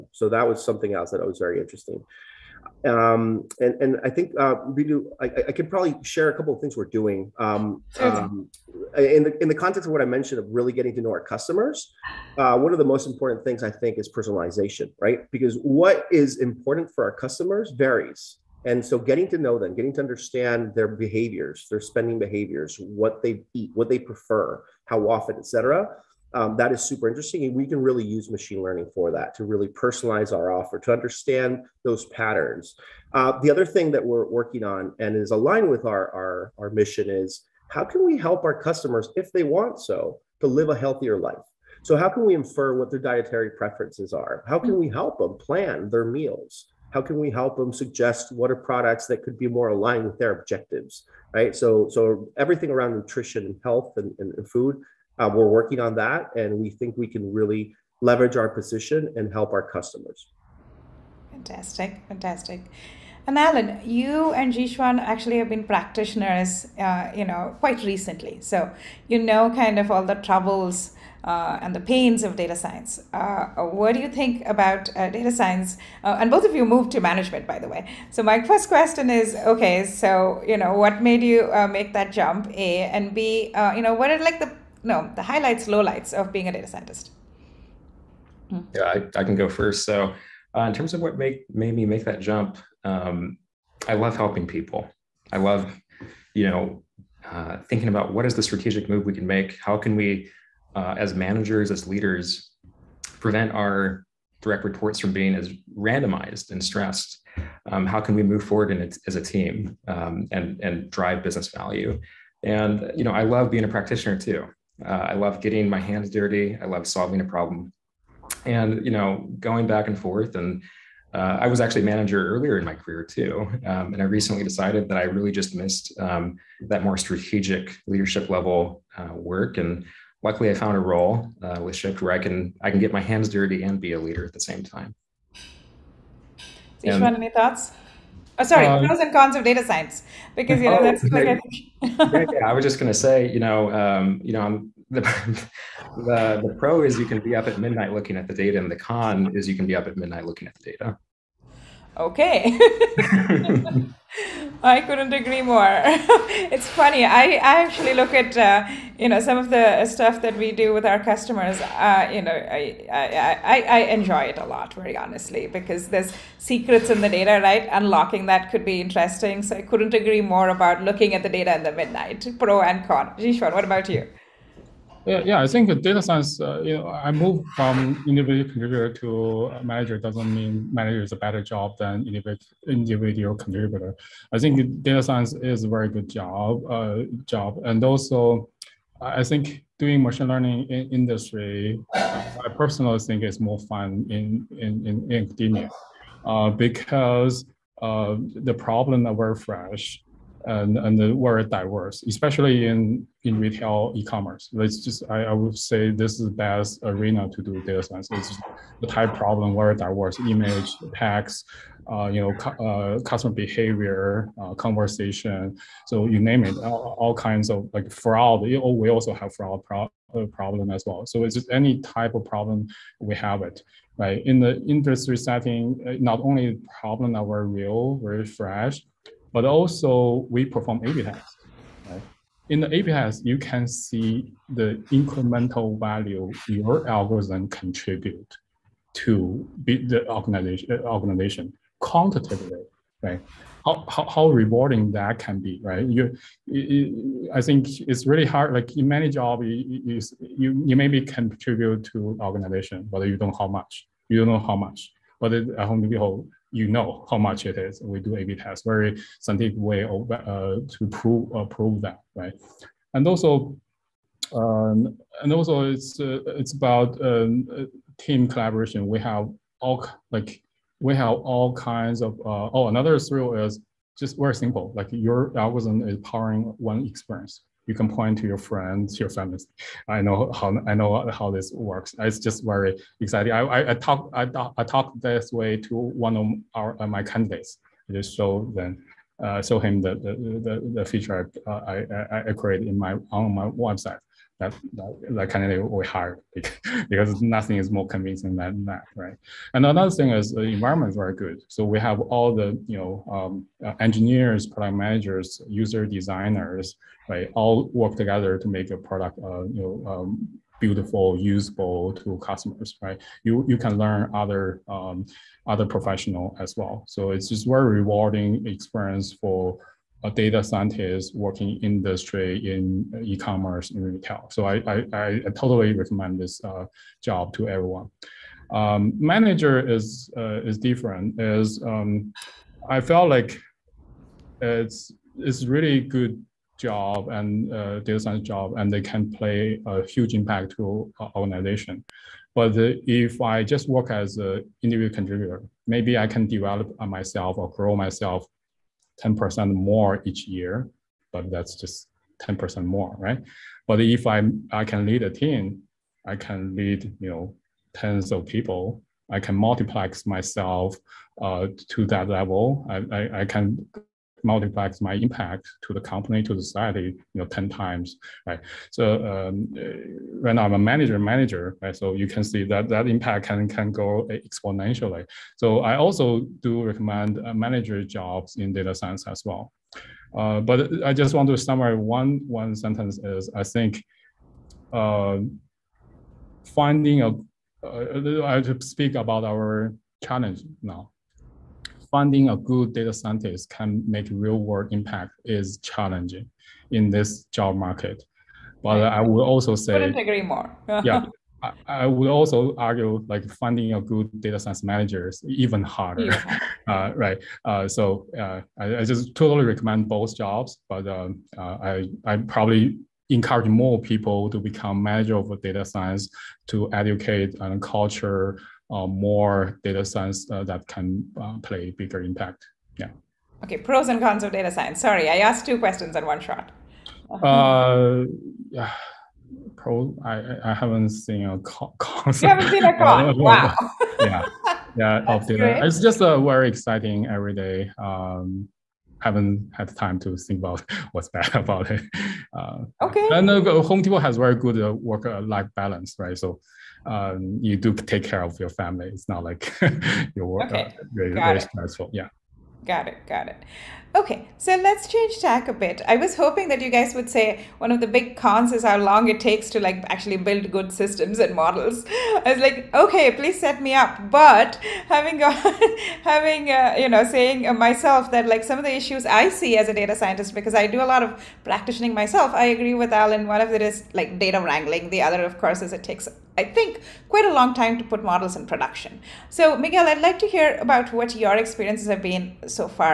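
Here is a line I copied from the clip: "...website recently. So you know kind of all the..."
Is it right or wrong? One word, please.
wrong.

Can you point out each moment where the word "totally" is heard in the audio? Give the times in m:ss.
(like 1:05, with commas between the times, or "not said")
5:25, 6:49.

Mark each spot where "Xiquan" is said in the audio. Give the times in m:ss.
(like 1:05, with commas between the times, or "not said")
1:04, 2:53.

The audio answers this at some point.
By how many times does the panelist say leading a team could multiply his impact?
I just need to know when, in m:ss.
6:07.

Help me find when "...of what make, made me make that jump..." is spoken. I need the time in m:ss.
1:30.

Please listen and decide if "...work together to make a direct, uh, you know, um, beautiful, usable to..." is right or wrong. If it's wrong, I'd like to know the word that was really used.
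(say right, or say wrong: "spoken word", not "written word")
wrong: "product", not "direct".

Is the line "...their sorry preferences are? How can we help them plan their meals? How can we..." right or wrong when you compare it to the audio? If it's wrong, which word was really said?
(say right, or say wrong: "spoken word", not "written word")
wrong: "dietary", not "sorry".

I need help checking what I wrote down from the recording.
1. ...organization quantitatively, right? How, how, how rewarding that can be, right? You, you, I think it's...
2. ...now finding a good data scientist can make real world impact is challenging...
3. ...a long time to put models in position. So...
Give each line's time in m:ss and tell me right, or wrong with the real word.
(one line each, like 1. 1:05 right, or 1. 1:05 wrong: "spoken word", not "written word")
1. 4:00 right
2. 6:30 right
3. 7:57 wrong: "production", not "position".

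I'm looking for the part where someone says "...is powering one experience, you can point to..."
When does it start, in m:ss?
4:35.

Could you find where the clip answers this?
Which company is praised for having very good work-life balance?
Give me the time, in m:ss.
7:23.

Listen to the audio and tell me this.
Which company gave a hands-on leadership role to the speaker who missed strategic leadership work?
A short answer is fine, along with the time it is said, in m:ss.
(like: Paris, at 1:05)
Shipt, at 2:11.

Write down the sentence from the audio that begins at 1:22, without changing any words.
A and B, you know, what are like the no, the highlights, lowlights of being a data scientist.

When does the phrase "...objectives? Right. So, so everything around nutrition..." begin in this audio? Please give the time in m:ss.
0:50.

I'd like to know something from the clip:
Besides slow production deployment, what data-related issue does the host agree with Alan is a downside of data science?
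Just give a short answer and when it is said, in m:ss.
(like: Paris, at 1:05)
Data wrangling, at 7:54.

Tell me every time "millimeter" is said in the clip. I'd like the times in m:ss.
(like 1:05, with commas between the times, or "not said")
not said.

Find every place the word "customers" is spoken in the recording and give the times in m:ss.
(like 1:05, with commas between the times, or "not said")
0:11, 0:17, 0:38, 0:59, 2:41, 3:33, 5:12.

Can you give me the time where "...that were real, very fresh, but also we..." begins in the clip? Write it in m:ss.
3:47.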